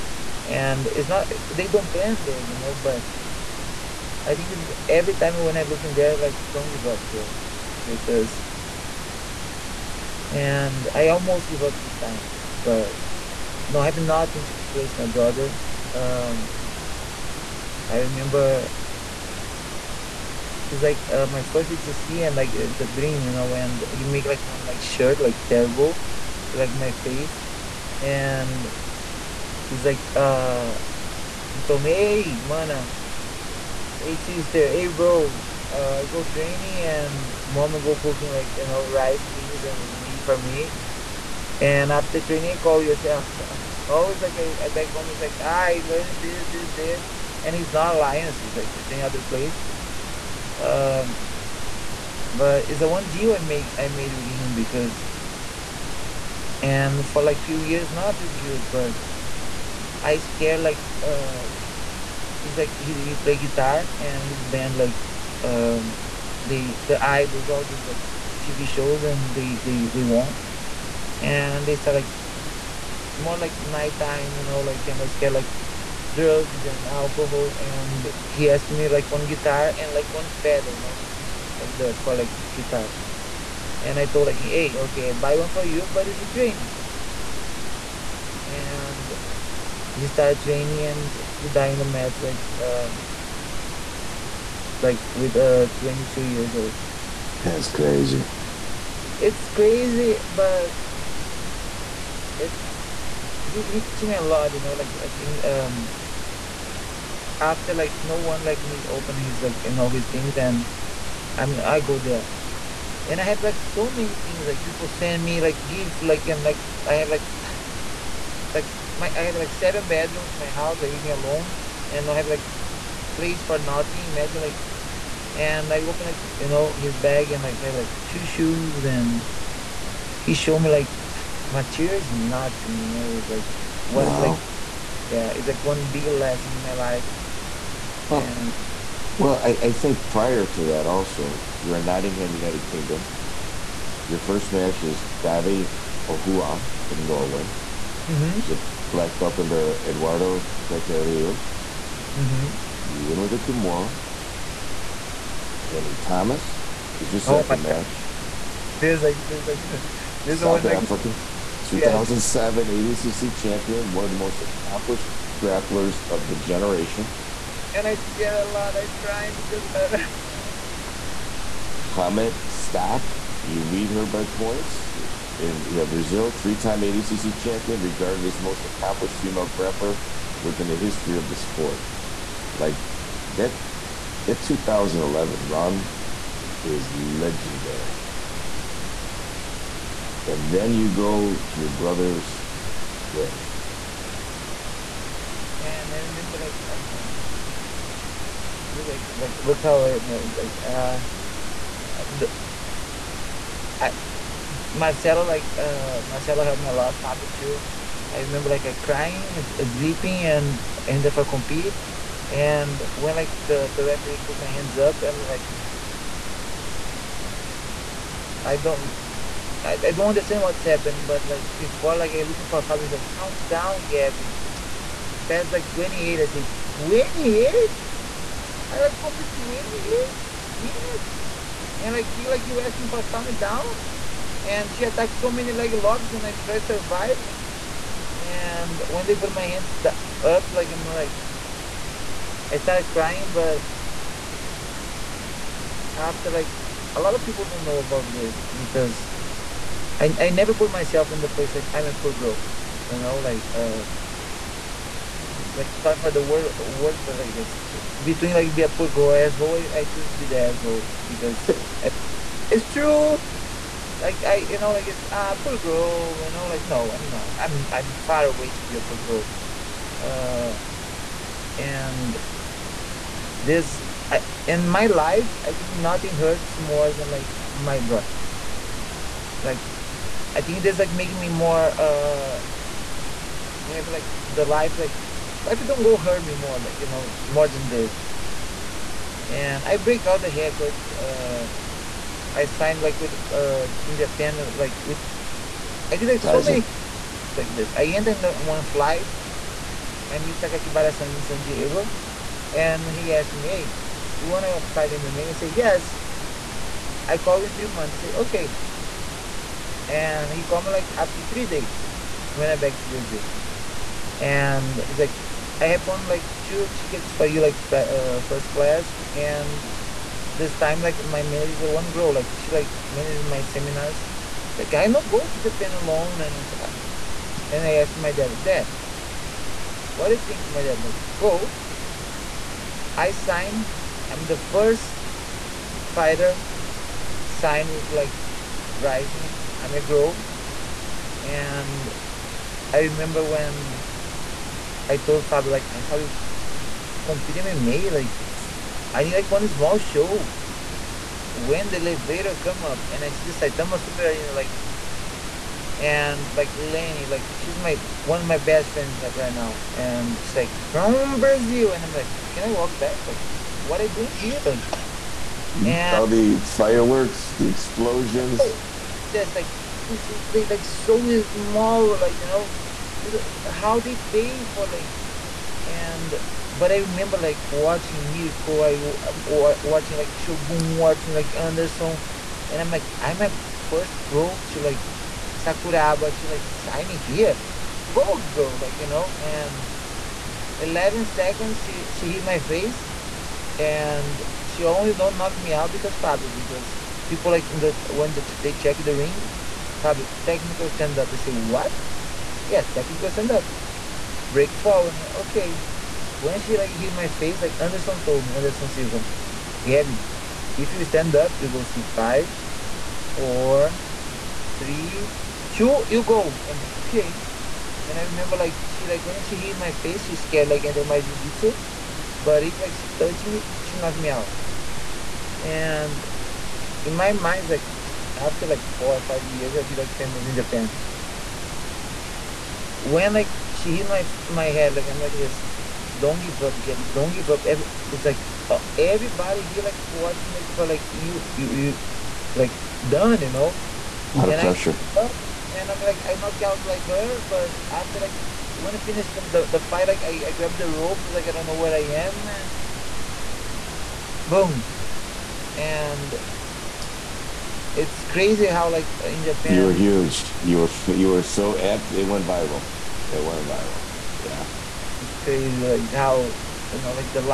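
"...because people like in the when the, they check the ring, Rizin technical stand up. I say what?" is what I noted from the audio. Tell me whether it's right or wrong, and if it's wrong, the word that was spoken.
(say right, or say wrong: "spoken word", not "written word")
wrong: "Fabio", not "Rizin".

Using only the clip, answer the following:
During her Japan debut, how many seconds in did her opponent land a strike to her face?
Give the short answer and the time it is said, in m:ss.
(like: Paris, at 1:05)
11, at 6:30.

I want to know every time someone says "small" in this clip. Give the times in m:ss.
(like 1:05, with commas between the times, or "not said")
5:49, 6:11.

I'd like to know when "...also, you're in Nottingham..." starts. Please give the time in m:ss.
2:20.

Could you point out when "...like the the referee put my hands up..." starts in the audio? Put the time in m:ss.
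3:33.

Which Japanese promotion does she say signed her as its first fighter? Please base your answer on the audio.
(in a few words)
Rizin.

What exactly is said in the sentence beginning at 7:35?
And it's crazy how like in Japan you were huge.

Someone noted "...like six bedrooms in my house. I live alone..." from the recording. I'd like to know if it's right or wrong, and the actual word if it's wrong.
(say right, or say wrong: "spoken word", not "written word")
wrong: "seven", not "six".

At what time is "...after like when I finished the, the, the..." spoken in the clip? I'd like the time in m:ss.
7:27.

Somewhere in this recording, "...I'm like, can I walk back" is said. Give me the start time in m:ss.
6:01.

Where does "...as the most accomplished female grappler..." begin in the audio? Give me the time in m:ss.
2:58.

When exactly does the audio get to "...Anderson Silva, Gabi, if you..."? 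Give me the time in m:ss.
6:48.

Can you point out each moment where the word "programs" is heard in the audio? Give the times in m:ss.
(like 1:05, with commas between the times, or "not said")
not said.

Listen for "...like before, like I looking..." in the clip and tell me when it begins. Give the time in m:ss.
3:41.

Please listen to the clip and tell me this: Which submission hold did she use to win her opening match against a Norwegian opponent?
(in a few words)
Kimura.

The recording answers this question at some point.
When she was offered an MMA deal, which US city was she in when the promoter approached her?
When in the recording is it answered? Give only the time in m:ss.
5:01.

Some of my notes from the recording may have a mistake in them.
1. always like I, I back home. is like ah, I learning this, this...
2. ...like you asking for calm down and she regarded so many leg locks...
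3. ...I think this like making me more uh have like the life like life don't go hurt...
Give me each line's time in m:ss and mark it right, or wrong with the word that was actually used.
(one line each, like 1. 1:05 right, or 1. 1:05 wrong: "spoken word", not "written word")
1. 0:43 right
2. 3:52 wrong: "attacked", not "regarded"
3. 4:40 right.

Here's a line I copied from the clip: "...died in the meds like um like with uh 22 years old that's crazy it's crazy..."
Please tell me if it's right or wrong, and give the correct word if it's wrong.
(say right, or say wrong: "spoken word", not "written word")
right.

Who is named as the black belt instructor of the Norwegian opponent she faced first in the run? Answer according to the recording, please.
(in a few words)
Eduardo Tete Rios.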